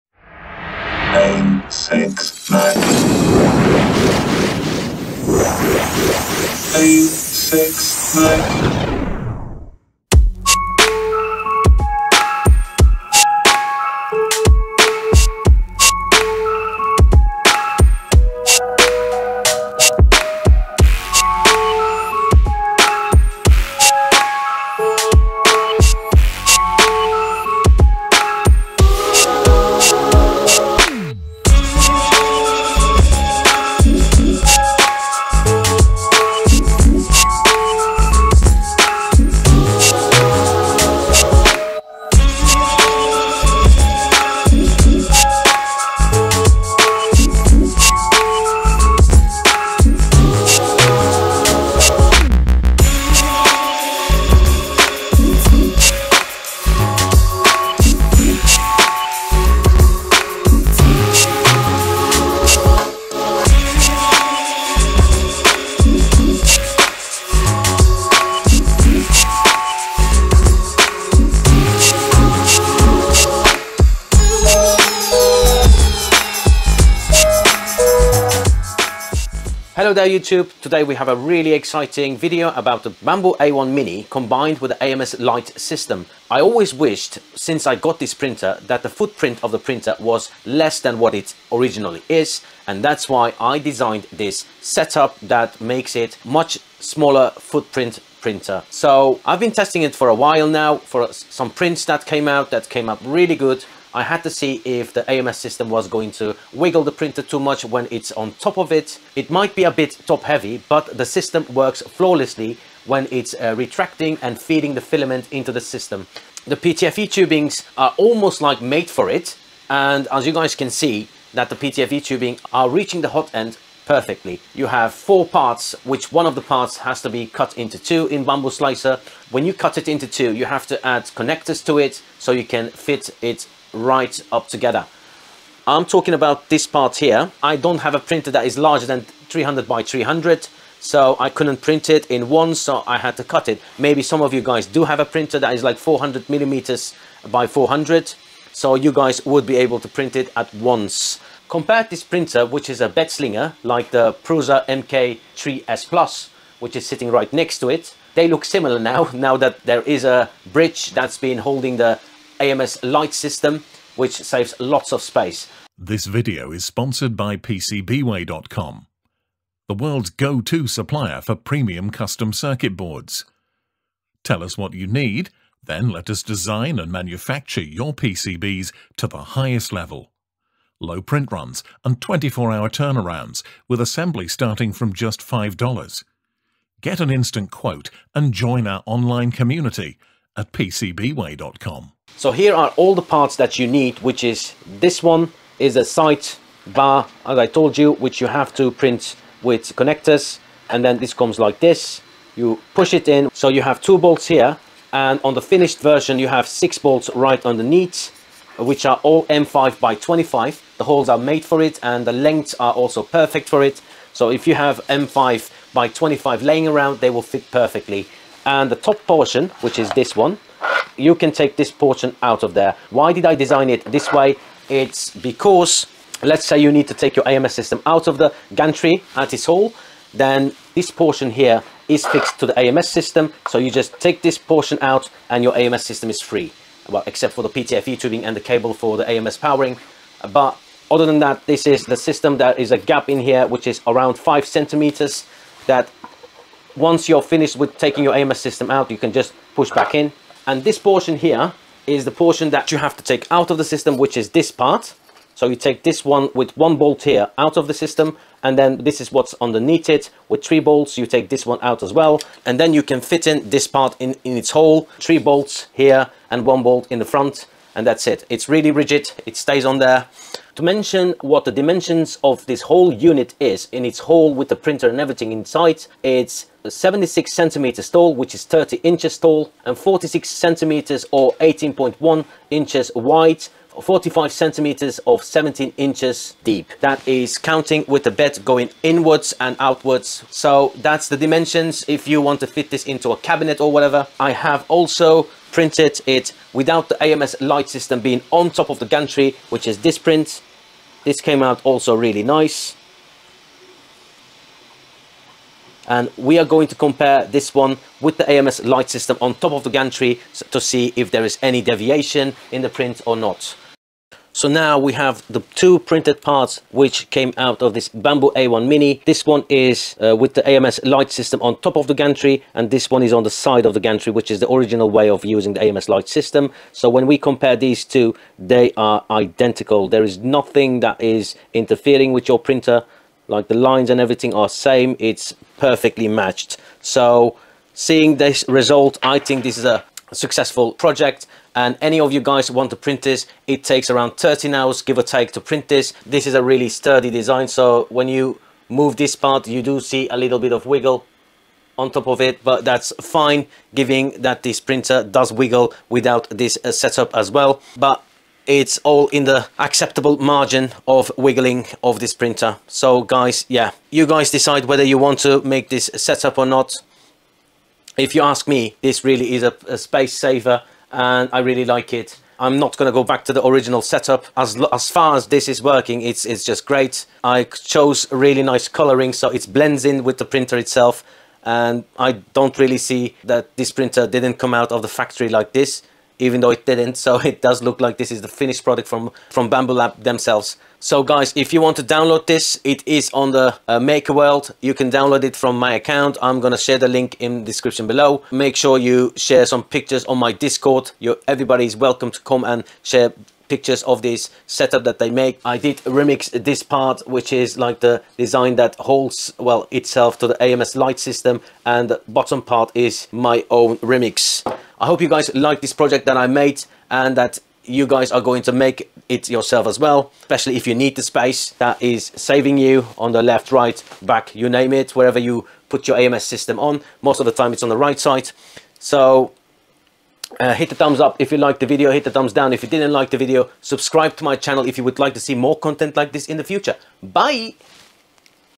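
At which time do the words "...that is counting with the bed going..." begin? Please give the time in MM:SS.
04:46.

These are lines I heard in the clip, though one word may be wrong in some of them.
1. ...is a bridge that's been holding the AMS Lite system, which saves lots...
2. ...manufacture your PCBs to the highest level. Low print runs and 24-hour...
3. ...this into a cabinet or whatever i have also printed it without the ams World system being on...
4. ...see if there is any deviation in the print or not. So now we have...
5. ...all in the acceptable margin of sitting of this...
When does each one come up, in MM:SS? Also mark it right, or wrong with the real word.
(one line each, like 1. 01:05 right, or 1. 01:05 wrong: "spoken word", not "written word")
1. 02:39 right
2. 02:56 right
3. 04:52 wrong: "Lite", not "World"
4. 05:10 right
5. 05:58 wrong: "wiggling", not "sitting".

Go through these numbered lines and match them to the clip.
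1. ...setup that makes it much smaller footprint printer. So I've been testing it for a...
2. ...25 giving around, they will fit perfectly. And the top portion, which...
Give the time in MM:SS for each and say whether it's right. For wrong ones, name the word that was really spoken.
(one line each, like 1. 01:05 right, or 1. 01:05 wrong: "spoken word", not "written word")
1. 01:34 right
2. 03:35 wrong: "laying", not "giving".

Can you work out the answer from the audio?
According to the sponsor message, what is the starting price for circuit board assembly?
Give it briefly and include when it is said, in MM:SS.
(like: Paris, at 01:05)
$5, at 03:05.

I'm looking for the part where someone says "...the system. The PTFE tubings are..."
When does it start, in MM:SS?
01:55.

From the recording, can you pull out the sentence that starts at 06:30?
So guys, if you want to download this, it is on the uh, World.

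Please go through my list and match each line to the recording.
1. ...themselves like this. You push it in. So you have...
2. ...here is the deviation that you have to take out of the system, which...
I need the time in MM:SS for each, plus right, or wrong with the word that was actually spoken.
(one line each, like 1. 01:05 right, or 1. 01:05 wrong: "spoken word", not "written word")
1. 03:21 wrong: "comes", not "themselves"
2. 04:11 wrong: "portion", not "deviation".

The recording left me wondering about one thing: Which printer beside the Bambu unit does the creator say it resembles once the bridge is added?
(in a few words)
Prusa MK3S Plus.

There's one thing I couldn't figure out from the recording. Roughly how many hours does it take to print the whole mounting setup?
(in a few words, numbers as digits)
13 hours.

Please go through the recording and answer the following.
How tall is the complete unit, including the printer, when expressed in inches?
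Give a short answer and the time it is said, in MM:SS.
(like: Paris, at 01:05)
30 inches, at 04:38.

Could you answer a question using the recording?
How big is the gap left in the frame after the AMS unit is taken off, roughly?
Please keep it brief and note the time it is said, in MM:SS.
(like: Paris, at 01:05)
5 centimeters, at 04:04.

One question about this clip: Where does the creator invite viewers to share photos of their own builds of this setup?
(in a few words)
Discord.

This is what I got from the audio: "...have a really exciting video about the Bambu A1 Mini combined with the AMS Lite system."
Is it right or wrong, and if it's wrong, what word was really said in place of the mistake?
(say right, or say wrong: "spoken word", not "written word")
right.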